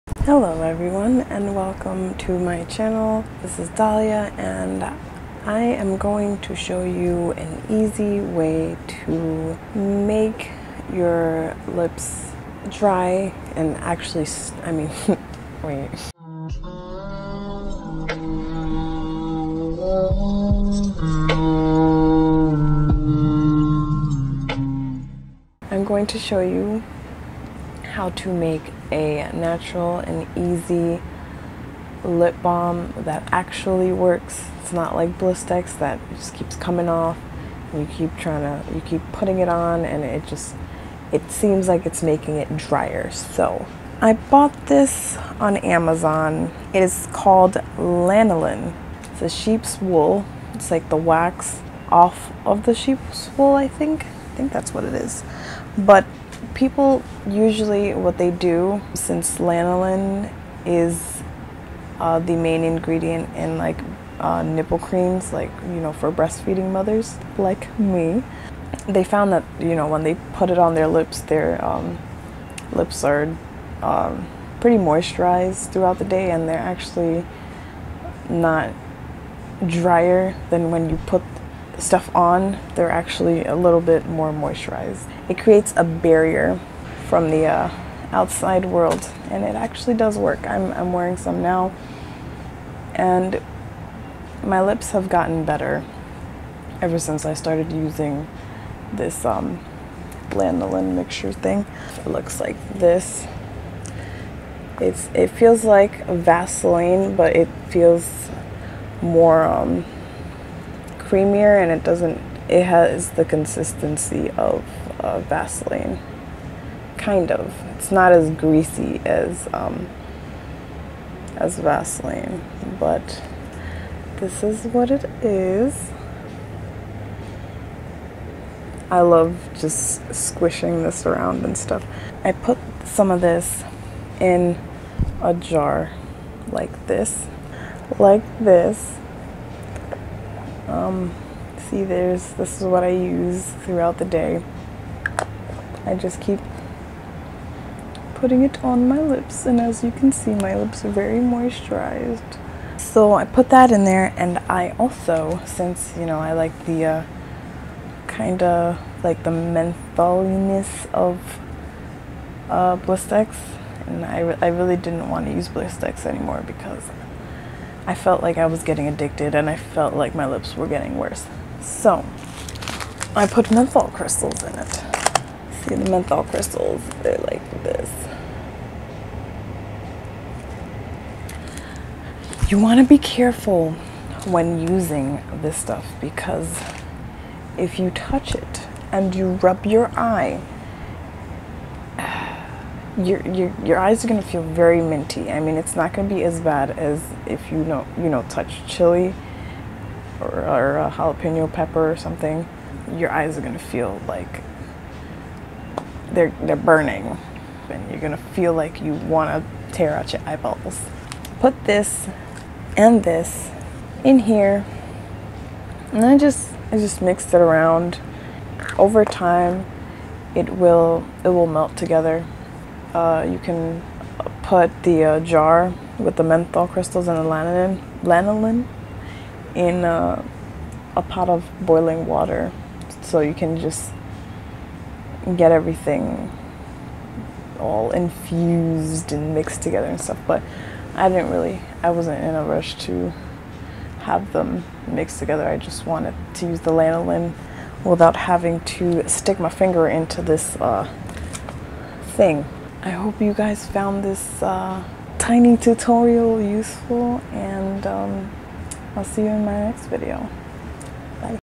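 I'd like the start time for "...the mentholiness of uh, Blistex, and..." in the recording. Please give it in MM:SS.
02:39.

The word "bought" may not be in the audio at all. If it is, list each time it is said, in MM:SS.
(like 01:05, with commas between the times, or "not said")
00:44.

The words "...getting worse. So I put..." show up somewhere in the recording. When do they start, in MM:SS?
02:50.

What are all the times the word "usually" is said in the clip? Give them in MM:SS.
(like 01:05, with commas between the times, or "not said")
00:57.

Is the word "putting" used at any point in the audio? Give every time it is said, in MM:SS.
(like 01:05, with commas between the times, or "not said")
00:39, 02:28.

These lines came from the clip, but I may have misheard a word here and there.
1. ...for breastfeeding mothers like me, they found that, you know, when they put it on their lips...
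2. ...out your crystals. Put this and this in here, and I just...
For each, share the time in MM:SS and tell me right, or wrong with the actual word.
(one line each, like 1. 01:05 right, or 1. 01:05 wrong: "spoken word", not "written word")
1. 01:05 right
2. 03:29 wrong: "eyeballs", not "crystals".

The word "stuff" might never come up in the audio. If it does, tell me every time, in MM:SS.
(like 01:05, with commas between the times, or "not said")
01:21, 02:11, 03:05, 04:00.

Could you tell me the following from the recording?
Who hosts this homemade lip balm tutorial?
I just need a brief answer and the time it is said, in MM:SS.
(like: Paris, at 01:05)
Dahlia, at 00:03.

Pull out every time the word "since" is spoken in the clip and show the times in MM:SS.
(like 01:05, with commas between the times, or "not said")
00:58, 01:36, 02:35.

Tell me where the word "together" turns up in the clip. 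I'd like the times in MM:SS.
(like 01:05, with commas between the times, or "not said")
03:41, 03:59, 04:05.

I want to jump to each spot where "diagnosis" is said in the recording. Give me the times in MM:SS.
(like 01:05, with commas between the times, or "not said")
not said.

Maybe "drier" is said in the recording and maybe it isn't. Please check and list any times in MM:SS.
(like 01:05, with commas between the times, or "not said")
00:42, 01:19.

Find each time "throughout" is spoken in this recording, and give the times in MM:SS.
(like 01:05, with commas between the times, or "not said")
01:15, 02:23.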